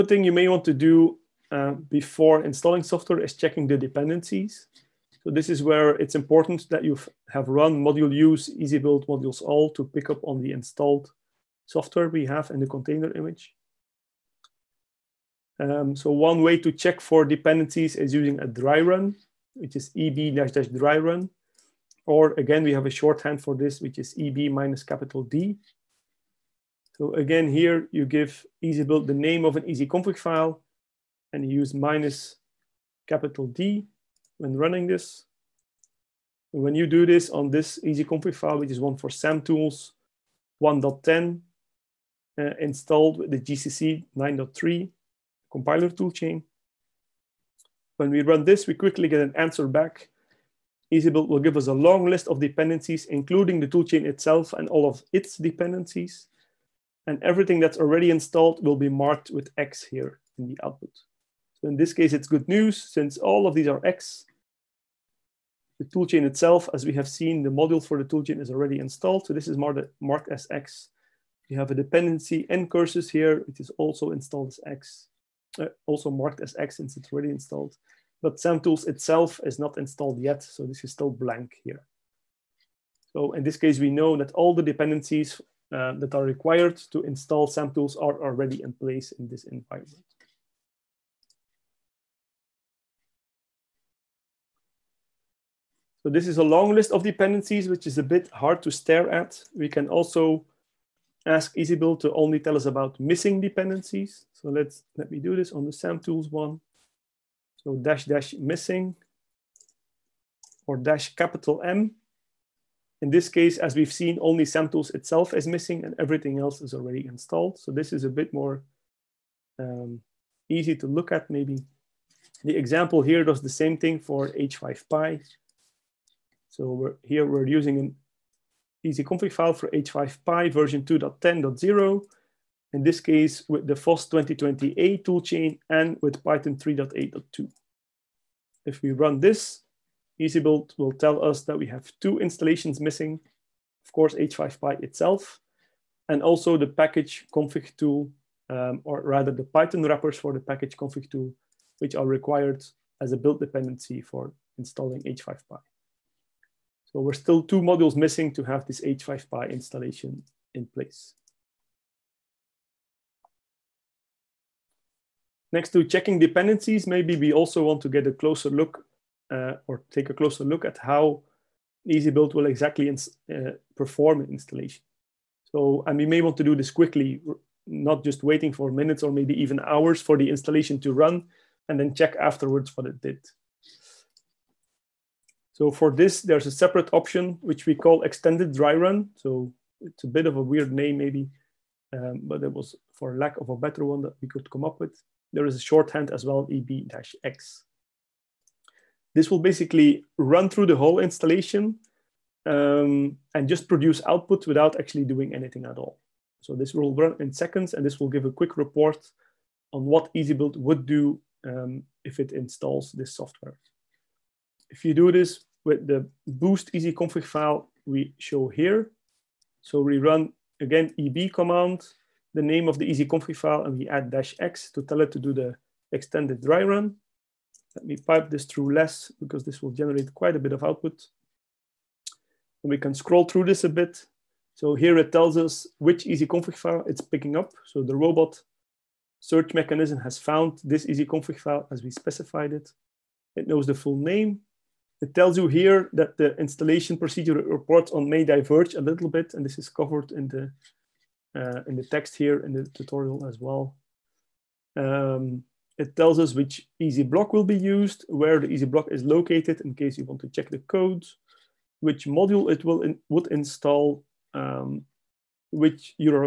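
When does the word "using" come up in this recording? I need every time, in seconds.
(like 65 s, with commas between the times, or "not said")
18 s, 127 s.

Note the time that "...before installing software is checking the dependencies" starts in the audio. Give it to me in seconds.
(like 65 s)
1 s.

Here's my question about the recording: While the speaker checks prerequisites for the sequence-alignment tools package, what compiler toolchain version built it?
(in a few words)
GCC 9.3.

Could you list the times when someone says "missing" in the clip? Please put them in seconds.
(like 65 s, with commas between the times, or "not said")
103 s, 108 s, 115 s, 142 s, 157 s.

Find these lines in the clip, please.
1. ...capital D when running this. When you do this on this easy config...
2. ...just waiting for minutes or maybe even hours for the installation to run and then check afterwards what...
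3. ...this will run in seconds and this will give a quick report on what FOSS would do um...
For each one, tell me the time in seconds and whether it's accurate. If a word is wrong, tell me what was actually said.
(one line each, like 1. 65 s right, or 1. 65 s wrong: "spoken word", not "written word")
1. 33 s right
2. 178 s right
3. 206 s wrong: "EasyBuild", not "FOSS".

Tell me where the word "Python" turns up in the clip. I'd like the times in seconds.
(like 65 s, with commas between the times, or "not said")
136 s, 149 s.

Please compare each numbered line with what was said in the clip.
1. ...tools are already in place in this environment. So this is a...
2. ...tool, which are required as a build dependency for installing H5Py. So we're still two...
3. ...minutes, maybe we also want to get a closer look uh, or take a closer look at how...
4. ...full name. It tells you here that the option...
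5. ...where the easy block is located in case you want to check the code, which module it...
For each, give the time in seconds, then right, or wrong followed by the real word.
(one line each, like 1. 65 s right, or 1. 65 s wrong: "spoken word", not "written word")
1. 87 s right
2. 151 s right
3. 166 s wrong: "dependencies", not "minutes"
4. 243 s wrong: "installation", not "option"
5. 258 s right.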